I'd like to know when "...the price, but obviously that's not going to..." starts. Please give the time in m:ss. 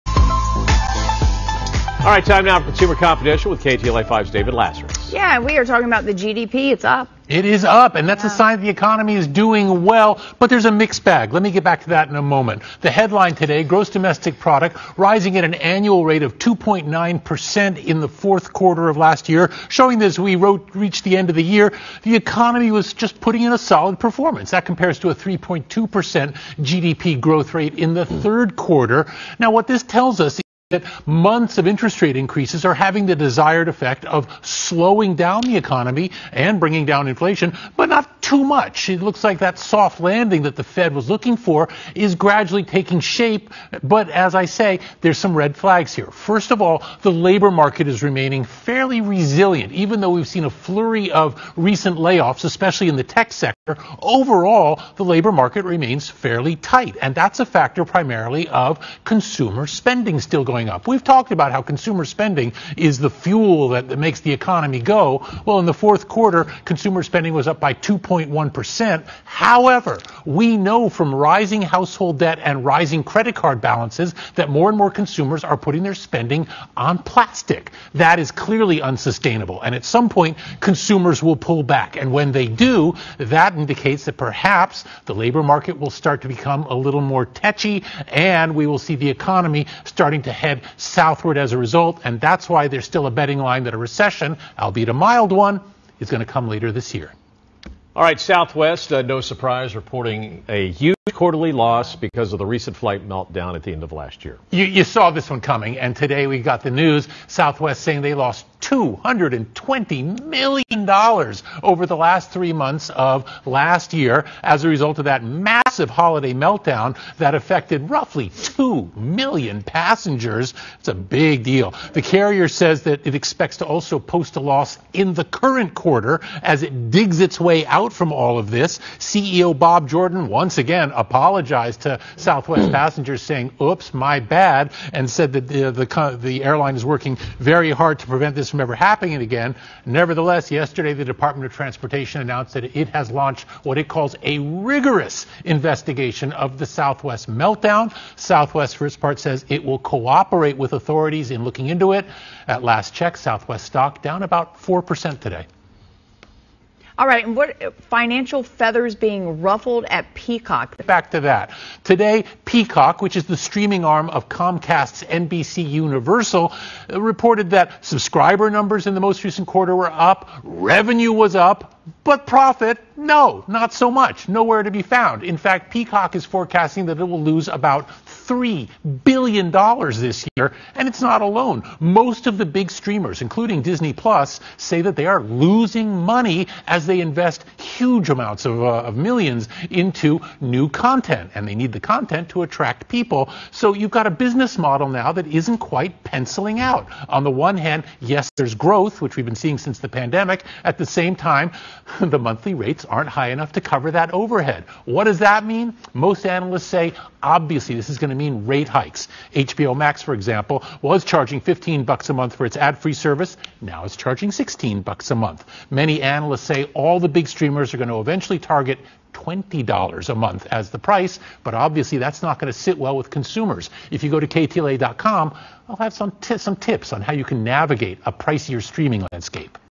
3:40.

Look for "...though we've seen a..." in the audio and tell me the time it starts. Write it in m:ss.
0:50.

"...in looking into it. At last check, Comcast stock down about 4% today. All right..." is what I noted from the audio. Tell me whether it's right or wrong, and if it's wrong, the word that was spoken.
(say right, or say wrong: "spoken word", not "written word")
wrong: "Southwest", not "Comcast".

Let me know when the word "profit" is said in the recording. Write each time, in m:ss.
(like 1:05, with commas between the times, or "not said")
2:52.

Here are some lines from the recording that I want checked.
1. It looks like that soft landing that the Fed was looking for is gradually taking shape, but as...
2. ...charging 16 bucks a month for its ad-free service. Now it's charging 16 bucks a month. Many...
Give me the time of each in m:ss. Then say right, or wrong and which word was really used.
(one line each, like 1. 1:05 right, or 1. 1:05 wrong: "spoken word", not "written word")
1. 0:38 right
2. 3:31 wrong: "15", not "16".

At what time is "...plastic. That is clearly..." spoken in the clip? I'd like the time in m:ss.
1:16.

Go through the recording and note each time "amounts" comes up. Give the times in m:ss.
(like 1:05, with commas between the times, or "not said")
3:08.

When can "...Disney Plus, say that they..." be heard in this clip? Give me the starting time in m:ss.
3:03.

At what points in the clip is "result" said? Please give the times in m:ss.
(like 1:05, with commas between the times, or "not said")
1:31, 1:54.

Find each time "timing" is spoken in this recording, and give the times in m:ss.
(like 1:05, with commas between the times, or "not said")
not said.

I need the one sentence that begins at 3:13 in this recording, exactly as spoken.
So you've got a business model now that isn't quite penciling out.